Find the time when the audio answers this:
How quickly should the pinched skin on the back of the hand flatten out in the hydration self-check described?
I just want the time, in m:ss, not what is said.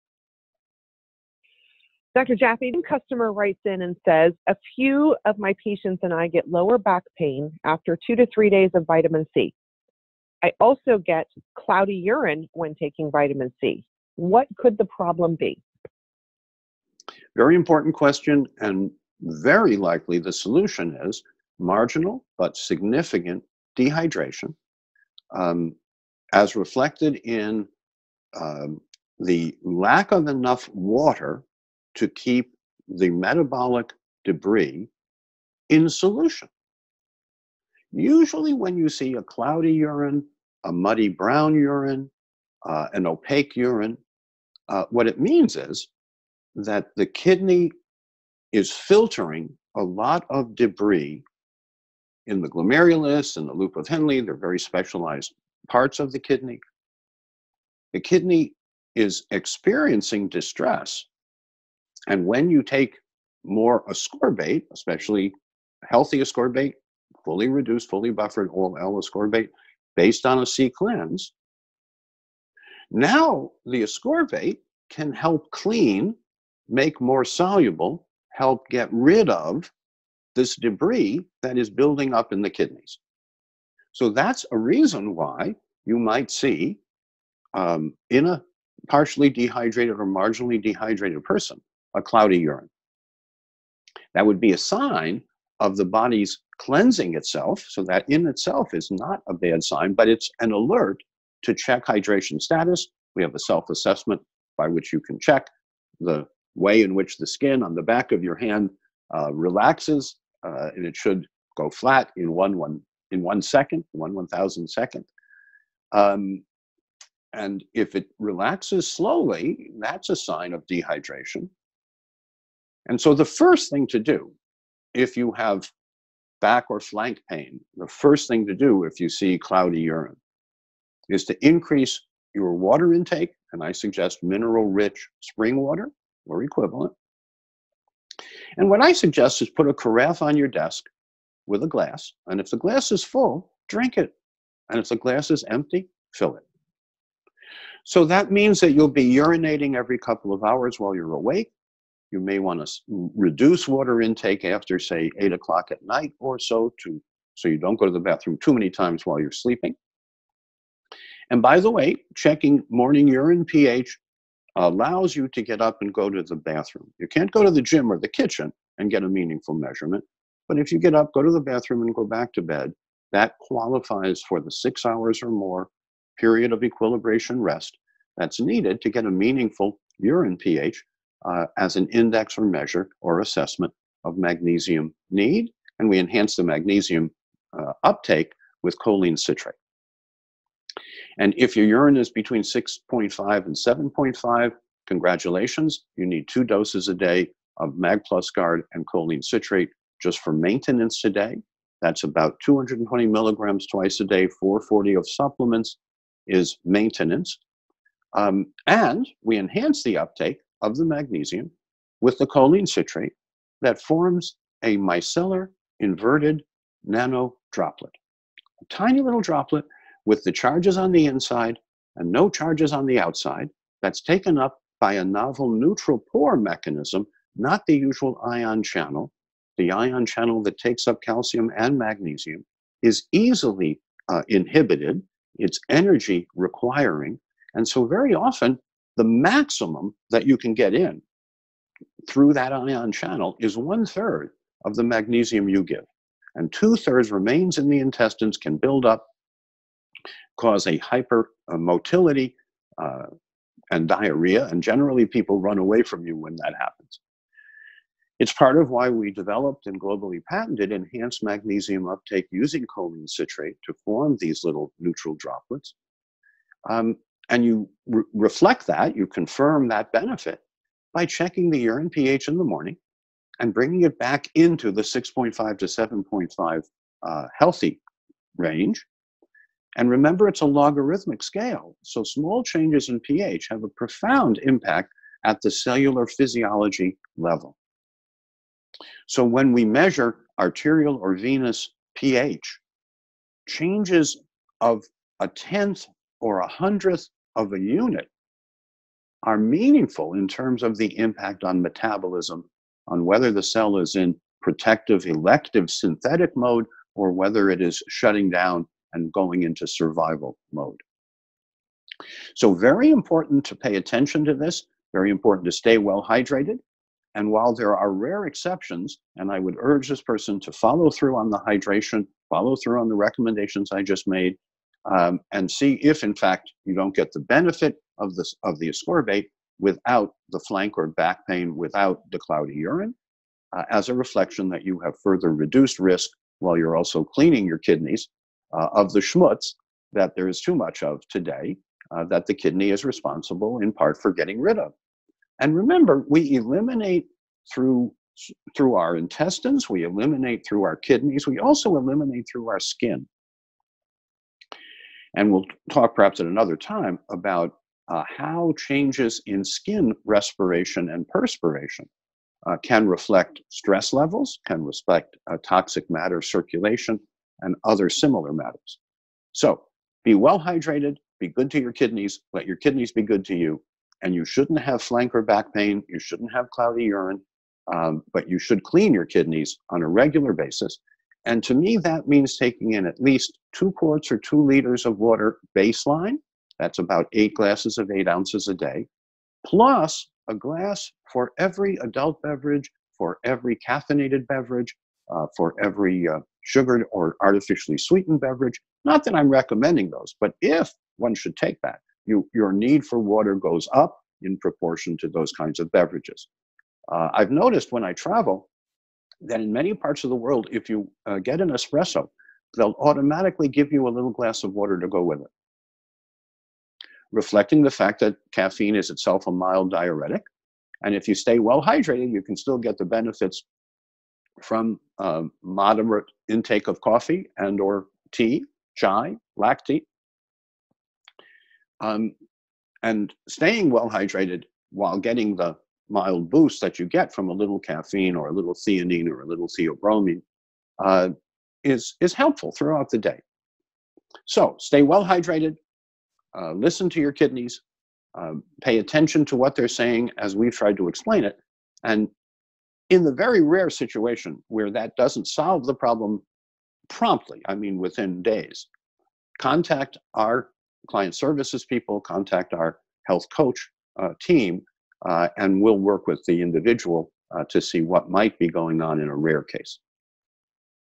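1:53.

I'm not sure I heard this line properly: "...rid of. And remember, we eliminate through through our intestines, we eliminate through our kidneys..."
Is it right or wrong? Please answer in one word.
right.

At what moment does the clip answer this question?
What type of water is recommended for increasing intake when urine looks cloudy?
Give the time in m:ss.
2:14.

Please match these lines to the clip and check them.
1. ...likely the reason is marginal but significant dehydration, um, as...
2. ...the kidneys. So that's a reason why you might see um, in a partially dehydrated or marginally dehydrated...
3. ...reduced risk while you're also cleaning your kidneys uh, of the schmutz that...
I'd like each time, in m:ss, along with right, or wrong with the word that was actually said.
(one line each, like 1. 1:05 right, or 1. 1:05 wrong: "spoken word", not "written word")
1. 0:19 wrong: "solution", not "reason"
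2. 1:22 right
3. 5:35 right.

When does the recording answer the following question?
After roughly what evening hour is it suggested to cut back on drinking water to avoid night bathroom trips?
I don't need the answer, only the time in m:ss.
2:35.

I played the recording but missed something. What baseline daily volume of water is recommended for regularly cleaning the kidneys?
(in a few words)
2 liters.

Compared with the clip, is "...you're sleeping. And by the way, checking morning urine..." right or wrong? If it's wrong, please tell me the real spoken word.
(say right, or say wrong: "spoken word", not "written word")
right.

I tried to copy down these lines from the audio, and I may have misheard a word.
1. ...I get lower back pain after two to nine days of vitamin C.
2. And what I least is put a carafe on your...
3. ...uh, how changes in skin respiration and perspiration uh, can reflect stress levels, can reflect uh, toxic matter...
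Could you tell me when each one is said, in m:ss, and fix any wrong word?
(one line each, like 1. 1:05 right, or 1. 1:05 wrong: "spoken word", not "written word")
1. 0:06 wrong: "three", not "nine"
2. 2:18 wrong: "suggest", not "least"
3. 5:57 right.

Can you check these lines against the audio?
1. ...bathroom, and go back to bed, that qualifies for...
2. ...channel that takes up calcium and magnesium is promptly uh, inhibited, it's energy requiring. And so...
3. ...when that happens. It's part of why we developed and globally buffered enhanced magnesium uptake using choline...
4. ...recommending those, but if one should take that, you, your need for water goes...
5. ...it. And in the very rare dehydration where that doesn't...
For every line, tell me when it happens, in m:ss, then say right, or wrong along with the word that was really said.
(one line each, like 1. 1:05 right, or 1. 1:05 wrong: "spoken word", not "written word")
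1. 2:51 right
2. 3:50 wrong: "easily", not "promptly"
3. 4:16 wrong: "patented", not "buffered"
4. 6:39 right
5. 7:31 wrong: "situation", not "dehydration".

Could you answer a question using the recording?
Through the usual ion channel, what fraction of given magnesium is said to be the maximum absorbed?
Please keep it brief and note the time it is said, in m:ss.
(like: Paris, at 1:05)
One third, at 4:03.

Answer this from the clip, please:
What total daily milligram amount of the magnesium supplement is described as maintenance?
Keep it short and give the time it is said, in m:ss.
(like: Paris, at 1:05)
440, at 3:24.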